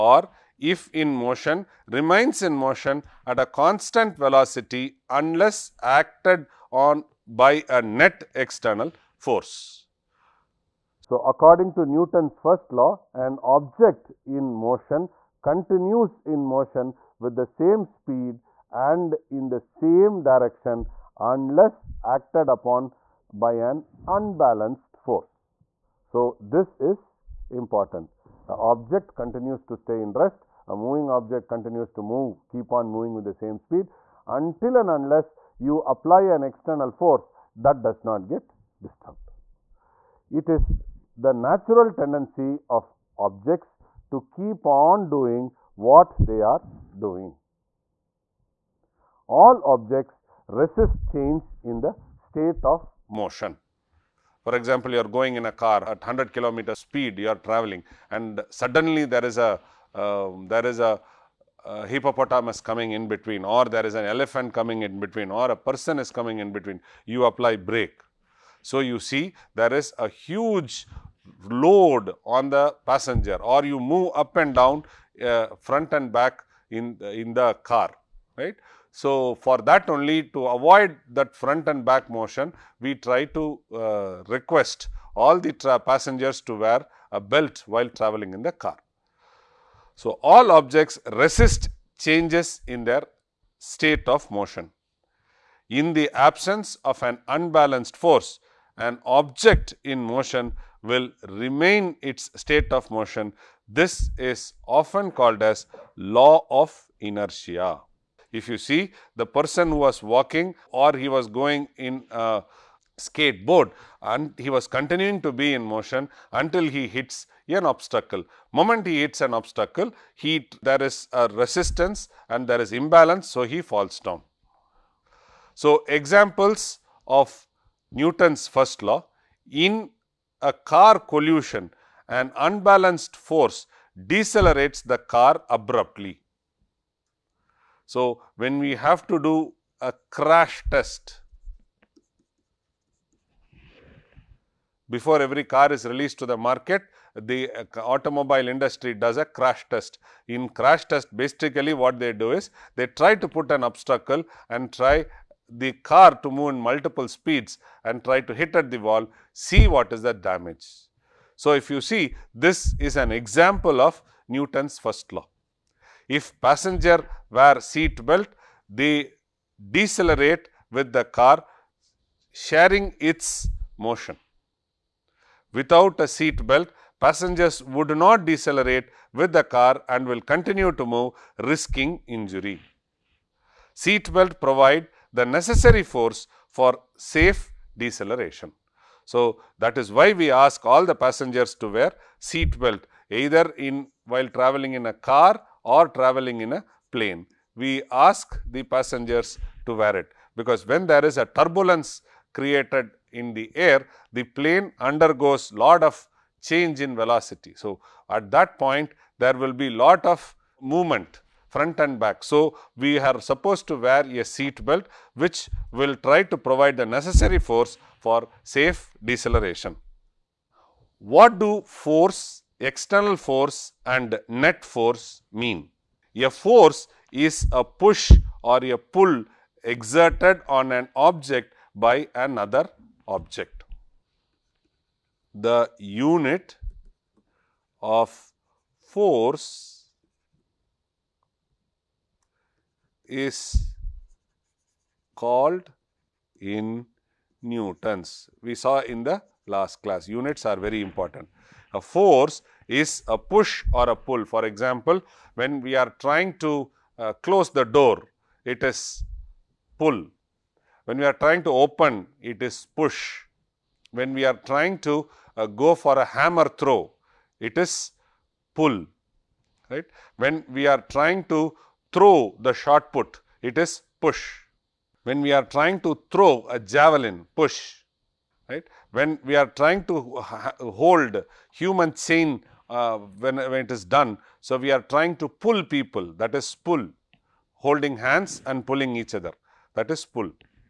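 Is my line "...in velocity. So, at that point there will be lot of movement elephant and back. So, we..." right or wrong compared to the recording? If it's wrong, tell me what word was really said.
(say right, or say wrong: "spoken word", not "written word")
wrong: "front", not "elephant".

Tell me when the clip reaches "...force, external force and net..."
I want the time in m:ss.
3:41.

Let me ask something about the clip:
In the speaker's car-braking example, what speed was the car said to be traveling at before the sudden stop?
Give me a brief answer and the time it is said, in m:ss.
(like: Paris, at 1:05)
100 kilometer, at 0:56.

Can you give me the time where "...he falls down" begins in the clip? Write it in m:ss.
2:03.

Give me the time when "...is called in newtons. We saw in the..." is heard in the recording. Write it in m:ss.
4:03.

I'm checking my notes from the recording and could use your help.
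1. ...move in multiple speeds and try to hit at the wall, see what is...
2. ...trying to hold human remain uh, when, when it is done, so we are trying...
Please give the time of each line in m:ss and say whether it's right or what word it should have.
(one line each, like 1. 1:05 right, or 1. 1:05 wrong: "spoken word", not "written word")
1. 2:36 right
2. 4:39 wrong: "chain", not "remain".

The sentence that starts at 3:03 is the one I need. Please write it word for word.
Seat belt provide the necessary force for safe deceleration.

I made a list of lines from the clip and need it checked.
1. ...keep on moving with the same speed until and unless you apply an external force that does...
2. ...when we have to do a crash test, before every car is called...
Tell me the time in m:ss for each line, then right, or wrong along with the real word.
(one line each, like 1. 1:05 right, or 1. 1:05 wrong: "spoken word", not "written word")
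1. 0:32 right
2. 2:18 wrong: "released", not "called".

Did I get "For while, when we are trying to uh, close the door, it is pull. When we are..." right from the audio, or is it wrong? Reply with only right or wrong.
wrong.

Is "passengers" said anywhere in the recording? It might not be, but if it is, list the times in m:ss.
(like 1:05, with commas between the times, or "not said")
1:12, 1:25, 2:46, 2:56, 3:10, 3:18.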